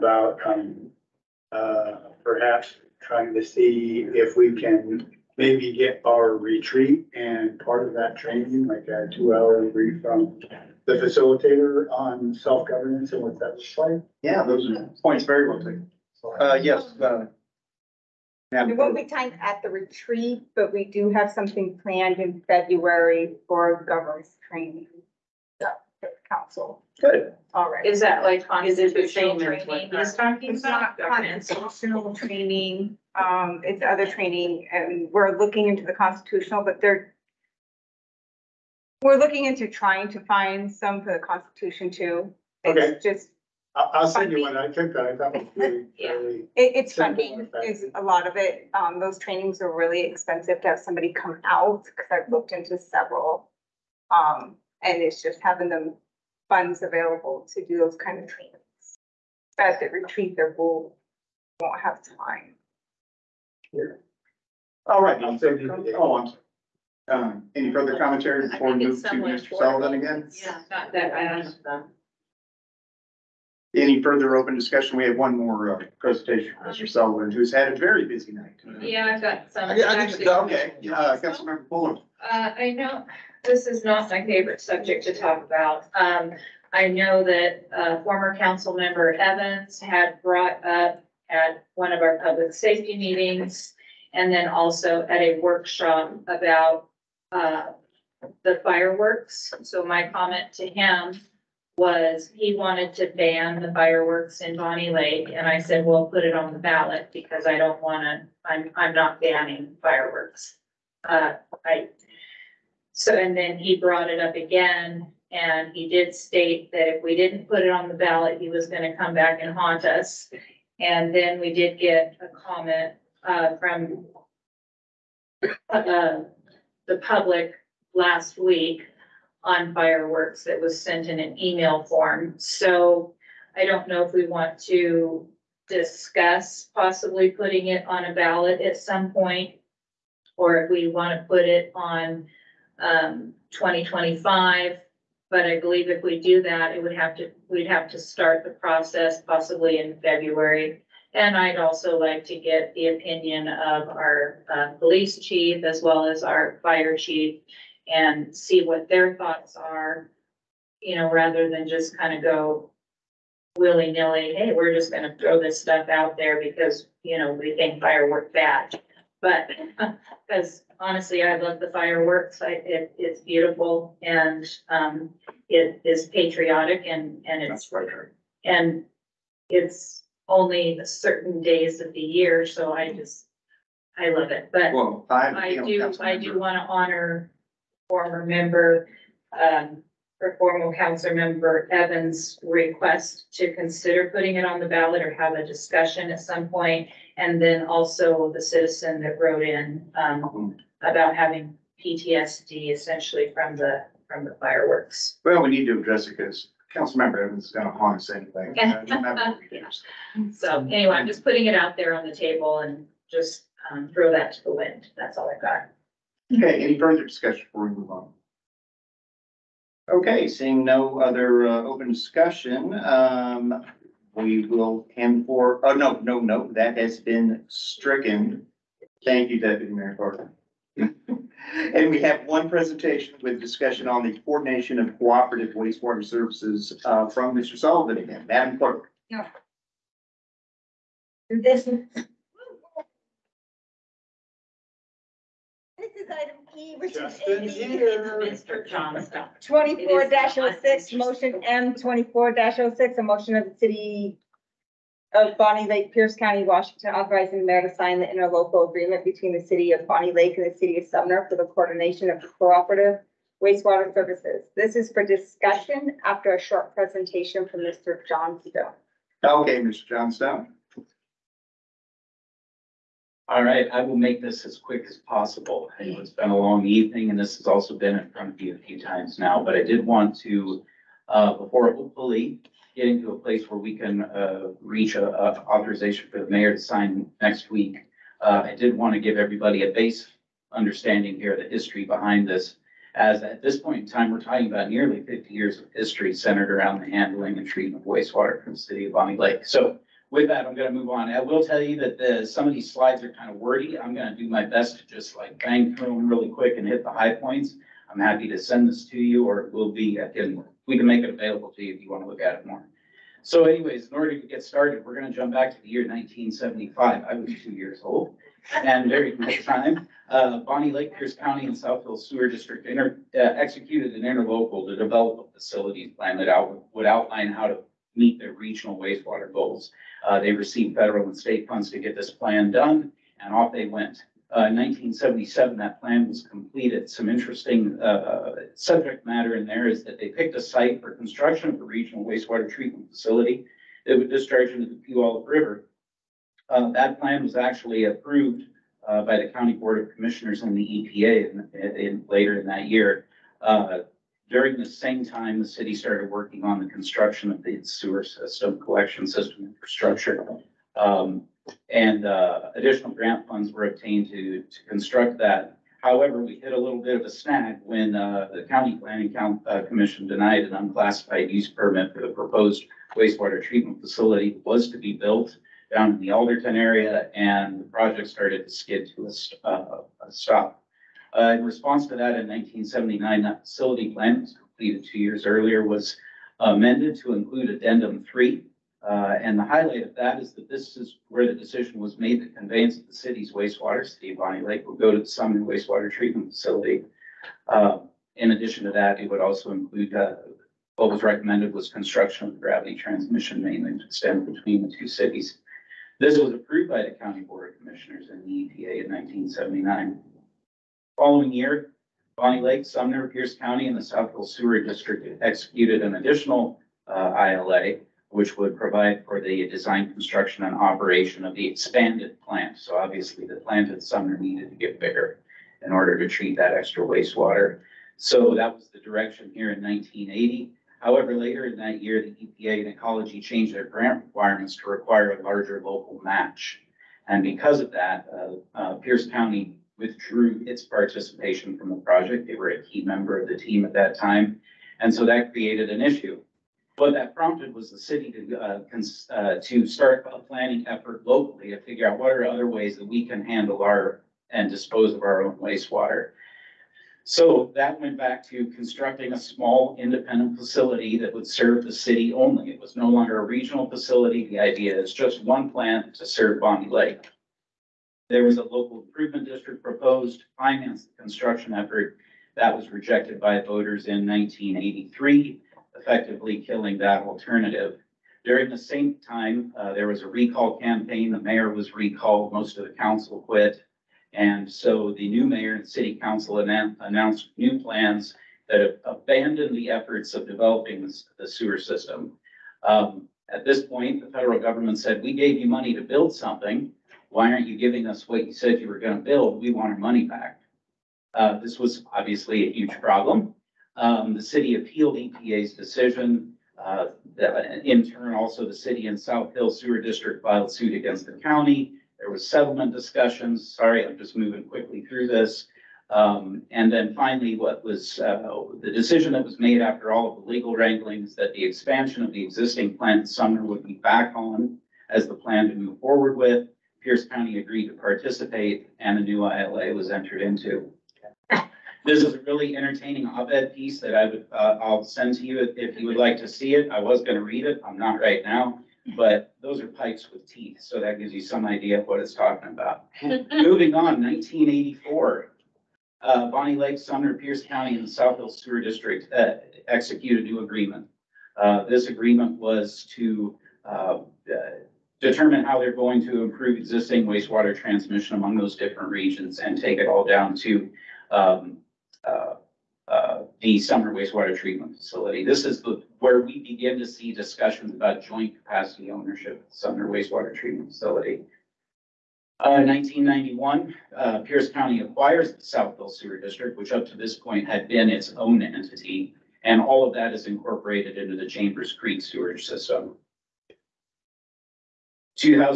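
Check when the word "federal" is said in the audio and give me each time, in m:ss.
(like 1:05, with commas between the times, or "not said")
5:30, 8:14.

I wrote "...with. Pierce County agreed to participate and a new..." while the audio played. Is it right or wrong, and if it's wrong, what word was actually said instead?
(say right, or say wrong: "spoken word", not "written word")
right.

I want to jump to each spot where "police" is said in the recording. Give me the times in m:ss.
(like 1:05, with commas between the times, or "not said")
2:34.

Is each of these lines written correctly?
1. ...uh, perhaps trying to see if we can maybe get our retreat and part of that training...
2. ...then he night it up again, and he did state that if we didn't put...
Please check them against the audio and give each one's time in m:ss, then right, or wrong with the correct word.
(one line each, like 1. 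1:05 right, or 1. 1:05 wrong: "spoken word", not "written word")
1. 0:01 right
2. 1:53 wrong: "brought", not "night".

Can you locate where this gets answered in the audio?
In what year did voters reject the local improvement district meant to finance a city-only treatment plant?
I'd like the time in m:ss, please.
7:54.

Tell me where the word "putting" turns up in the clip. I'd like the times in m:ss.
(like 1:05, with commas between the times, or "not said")
2:17, 3:14, 3:31.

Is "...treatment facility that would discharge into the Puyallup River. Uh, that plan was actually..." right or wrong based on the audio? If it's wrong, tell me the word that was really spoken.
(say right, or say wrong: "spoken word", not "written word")
right.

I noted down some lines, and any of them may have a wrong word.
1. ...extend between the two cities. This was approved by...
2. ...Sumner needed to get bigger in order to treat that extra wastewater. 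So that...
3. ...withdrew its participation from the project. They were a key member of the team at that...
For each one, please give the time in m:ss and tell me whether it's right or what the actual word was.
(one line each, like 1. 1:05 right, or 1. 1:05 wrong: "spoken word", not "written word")
1. 6:43 right
2. 7:03 right
3. 7:19 right.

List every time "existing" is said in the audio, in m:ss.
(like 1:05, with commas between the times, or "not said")
8:42, 9:16.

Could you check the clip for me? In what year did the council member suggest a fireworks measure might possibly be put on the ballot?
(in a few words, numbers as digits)
2025.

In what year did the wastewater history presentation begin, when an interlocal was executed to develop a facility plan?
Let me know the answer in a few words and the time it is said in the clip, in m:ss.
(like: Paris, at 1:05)
1975, at 5:15.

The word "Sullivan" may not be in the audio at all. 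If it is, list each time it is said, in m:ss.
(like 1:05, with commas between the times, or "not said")
1:09, 1:16, 3:57.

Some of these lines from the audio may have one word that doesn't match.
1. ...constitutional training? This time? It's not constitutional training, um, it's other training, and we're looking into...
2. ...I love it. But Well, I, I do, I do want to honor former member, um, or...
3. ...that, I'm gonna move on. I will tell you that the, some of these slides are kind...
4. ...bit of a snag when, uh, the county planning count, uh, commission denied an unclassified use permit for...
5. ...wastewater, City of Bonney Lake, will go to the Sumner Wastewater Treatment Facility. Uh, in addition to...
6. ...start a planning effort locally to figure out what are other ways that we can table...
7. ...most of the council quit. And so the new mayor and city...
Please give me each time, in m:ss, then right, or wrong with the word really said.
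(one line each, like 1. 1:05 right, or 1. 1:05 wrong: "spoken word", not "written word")
1. 0:28 right
2. 3:03 right
3. 5:00 right
4. 6:06 right
5. 6:33 right
6. 7:29 wrong: "handle", not "table"
7. 8:02 right.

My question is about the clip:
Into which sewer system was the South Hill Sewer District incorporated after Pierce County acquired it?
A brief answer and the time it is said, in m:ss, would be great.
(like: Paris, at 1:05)
Chambers Creek, at 9:41.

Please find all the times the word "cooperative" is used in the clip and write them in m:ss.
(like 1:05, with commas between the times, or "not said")
3:54, 4:22.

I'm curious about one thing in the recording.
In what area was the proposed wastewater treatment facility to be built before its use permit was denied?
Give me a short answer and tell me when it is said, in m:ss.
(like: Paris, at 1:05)
Alderton, at 6:16.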